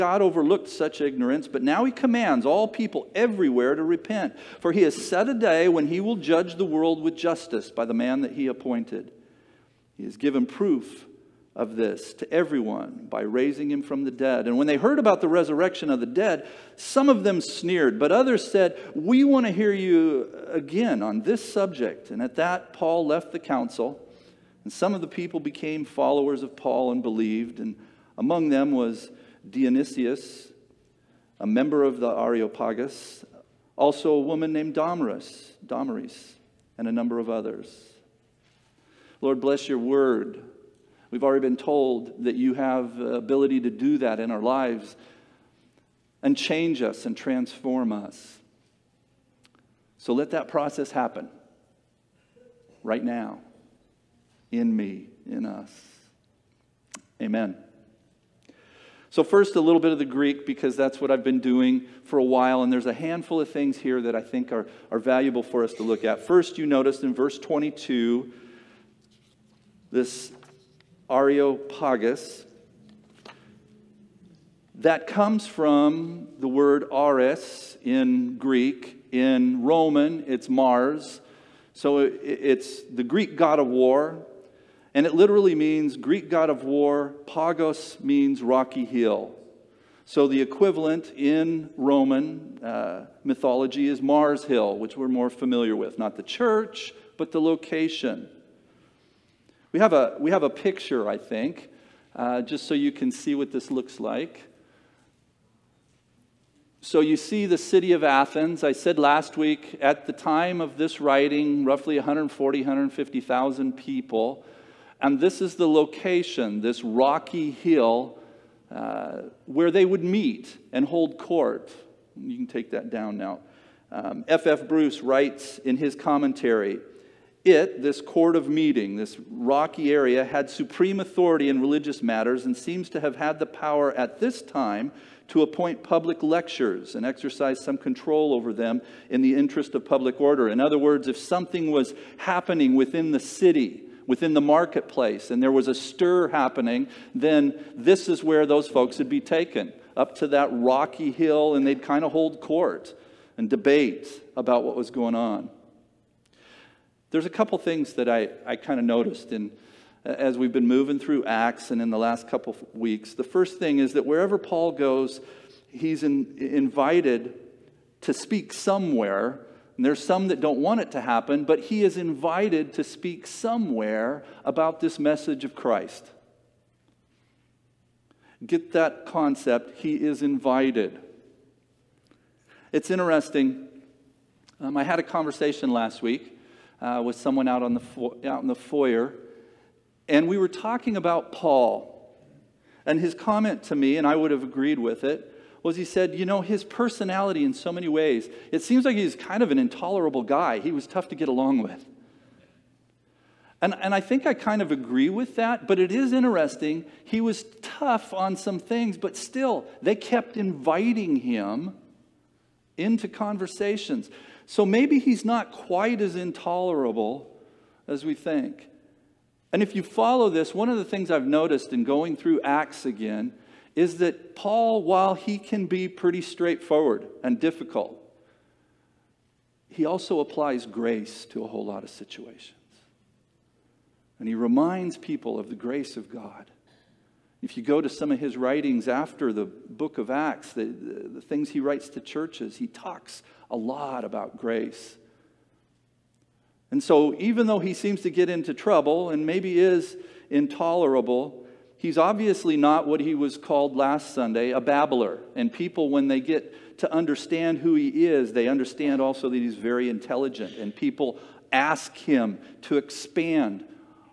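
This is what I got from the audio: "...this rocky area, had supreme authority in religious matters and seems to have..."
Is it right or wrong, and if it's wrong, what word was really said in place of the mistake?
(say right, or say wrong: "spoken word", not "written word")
right.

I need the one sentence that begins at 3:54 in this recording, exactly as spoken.
And he reminds people of the grace of God.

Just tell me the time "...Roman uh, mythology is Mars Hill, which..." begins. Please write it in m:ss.
1:31.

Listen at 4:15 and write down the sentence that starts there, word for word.
And people, when they get to understand who he is, they understand also that he's very intelligent.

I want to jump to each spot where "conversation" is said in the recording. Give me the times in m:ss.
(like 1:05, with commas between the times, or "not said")
3:05, 3:33.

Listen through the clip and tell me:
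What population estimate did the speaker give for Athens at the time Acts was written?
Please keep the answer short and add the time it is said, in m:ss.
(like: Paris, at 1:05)
140,000-150,000, at 1:51.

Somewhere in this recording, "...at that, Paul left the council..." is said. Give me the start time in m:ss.
0:22.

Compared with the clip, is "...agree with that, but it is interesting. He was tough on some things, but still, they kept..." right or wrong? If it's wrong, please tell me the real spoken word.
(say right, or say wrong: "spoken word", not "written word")
right.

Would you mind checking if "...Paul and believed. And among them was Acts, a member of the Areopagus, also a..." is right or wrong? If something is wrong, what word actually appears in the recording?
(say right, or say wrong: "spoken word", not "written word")
wrong: "Dionysius", not "Acts".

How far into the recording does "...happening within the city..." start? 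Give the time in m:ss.
2:22.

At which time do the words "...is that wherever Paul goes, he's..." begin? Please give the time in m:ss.
2:43.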